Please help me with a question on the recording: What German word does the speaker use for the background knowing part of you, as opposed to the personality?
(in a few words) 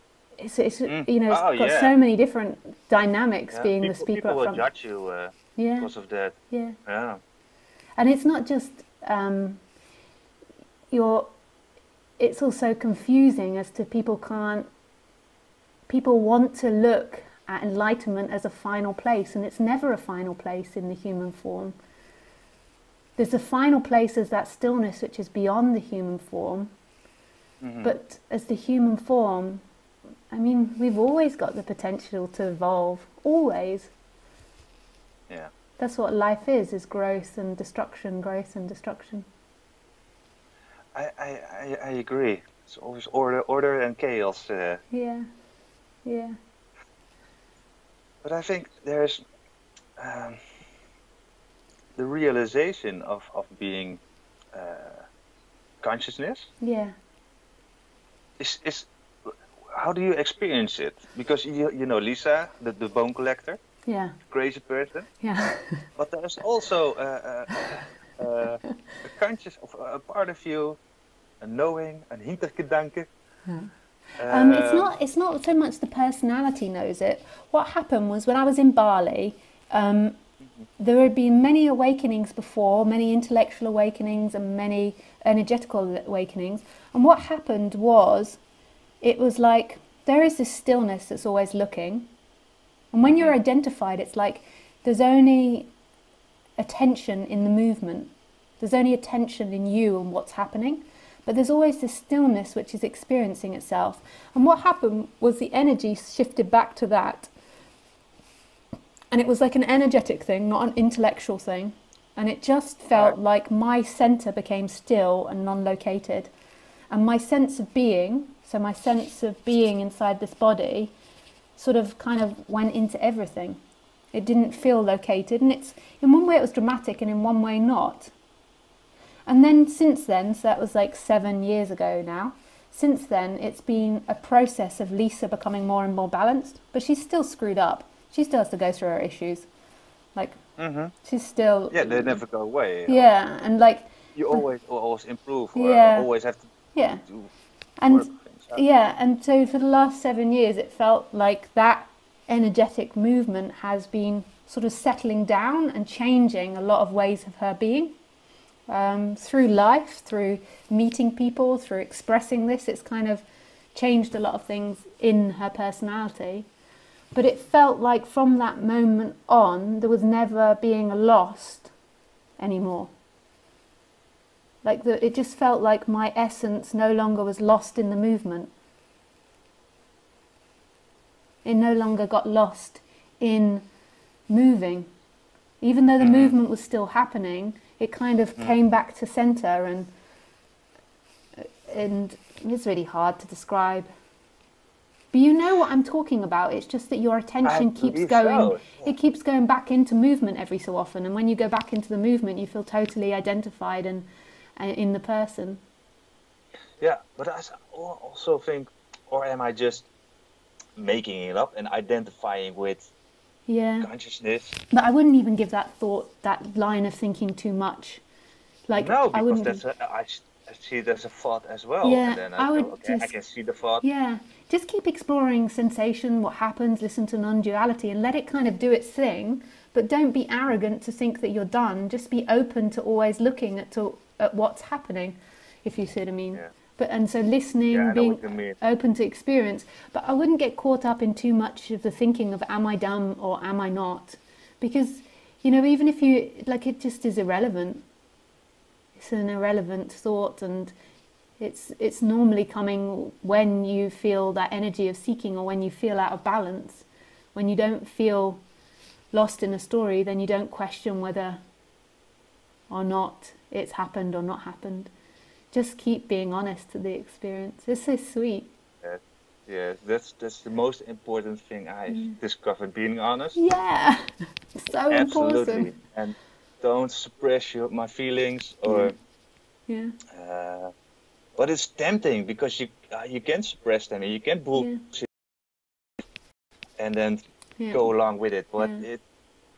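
hintergedanke.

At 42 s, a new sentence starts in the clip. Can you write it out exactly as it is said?
It's always order, order and chaos.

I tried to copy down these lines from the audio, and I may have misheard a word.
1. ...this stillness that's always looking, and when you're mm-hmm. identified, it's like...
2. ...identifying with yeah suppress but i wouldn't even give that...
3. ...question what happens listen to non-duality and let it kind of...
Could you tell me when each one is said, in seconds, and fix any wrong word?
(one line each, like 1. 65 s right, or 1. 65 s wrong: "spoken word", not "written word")
1. 90 s right
2. 211 s wrong: "consciousness", not "suppress"
3. 225 s wrong: "sensation", not "question".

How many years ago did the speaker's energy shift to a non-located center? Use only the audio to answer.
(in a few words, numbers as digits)
7.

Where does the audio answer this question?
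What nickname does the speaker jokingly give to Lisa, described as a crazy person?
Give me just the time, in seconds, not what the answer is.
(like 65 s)
62 s.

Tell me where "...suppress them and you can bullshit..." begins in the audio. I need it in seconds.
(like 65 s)
283 s.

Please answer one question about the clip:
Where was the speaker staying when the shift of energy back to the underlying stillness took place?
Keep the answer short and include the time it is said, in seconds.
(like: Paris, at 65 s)
Bali, at 78 s.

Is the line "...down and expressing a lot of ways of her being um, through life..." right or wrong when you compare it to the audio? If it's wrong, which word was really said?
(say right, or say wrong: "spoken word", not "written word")
wrong: "changing", not "expressing".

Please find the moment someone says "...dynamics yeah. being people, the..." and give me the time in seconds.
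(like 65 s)
2 s.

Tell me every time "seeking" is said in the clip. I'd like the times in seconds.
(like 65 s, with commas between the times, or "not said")
254 s.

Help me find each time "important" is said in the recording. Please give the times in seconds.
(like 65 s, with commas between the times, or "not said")
270 s, 274 s.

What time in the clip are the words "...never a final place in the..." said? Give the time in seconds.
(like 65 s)
19 s.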